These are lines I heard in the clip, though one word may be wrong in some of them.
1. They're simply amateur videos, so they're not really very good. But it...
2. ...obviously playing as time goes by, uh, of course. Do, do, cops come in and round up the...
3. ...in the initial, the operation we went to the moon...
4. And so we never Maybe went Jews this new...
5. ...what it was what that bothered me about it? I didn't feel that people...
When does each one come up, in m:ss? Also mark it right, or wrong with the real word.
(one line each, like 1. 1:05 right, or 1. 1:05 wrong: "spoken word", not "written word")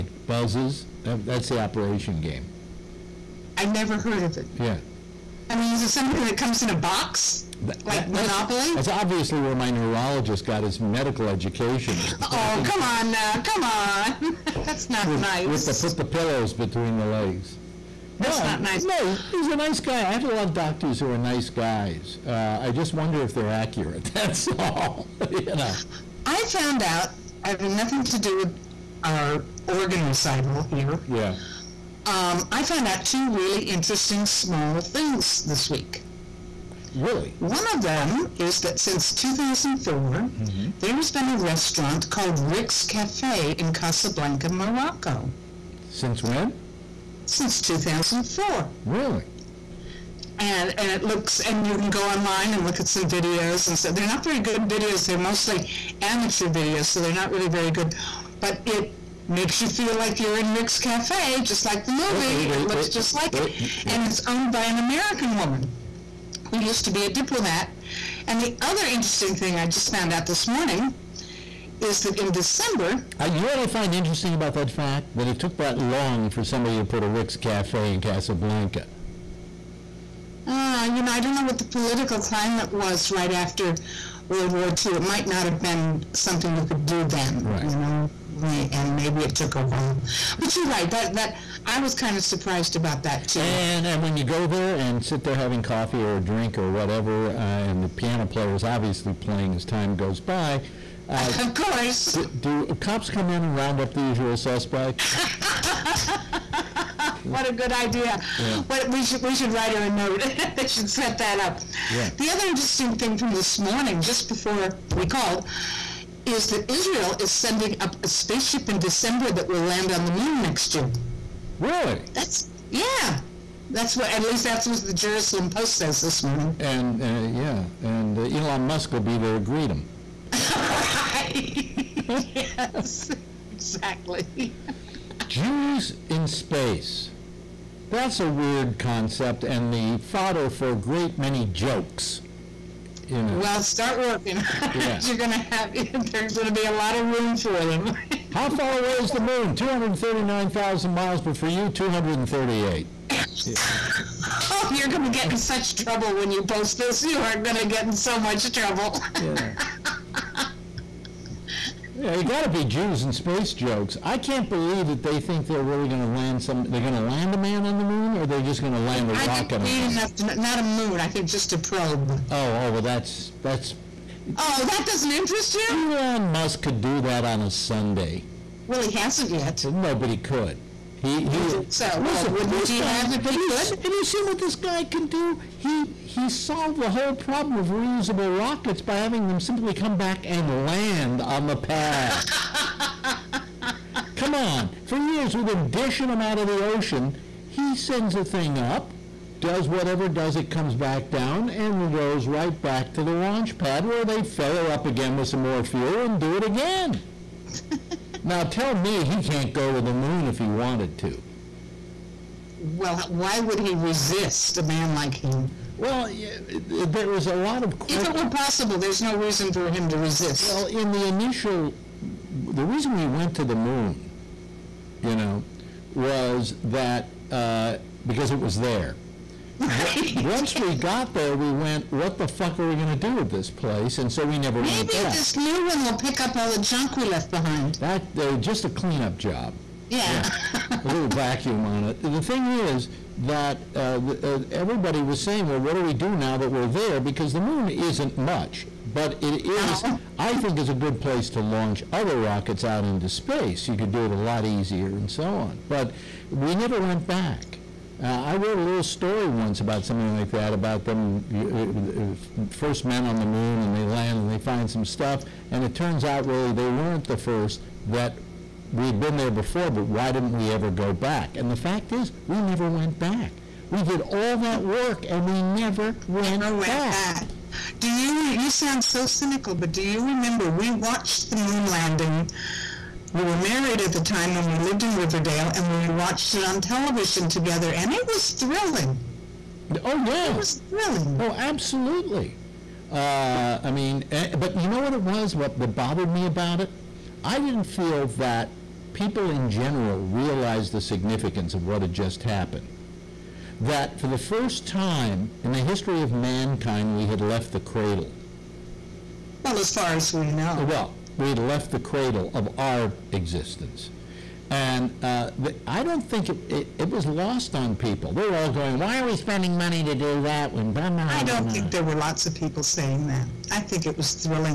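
1. 0:55 wrong: "mostly", not "simply"
2. 1:38 right
3. 3:40 wrong: "reason", not "operation"
4. 3:53 wrong: "Maybe", not "Jews"
5. 4:54 right.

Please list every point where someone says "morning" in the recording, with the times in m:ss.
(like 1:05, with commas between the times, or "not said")
1:10, 1:53, 2:06.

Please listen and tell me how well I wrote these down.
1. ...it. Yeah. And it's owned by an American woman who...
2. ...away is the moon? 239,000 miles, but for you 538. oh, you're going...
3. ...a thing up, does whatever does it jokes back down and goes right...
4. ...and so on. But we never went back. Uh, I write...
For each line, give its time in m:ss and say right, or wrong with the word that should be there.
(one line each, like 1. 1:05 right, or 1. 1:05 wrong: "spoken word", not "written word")
1. 1:03 right
2. 2:28 wrong: "238", not "538"
3. 3:18 wrong: "comes", not "jokes"
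4. 4:14 wrong: "wrote", not "write".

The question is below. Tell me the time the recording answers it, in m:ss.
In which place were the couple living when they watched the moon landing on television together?
4:44.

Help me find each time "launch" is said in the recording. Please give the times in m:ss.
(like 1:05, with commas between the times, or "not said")
3:23, 4:11.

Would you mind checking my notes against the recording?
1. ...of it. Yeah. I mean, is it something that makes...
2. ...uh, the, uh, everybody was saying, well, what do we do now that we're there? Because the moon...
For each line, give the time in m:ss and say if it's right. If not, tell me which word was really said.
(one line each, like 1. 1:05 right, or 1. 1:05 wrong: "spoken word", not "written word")
1. 0:04 wrong: "comes", not "makes"
2. 4:03 right.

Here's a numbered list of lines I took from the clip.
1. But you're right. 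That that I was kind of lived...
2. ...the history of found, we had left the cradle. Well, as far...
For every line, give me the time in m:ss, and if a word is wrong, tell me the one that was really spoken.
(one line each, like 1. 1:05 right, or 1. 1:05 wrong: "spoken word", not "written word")
1. 1:30 wrong: "surprised", not "lived"
2. 5:05 wrong: "mankind", not "found".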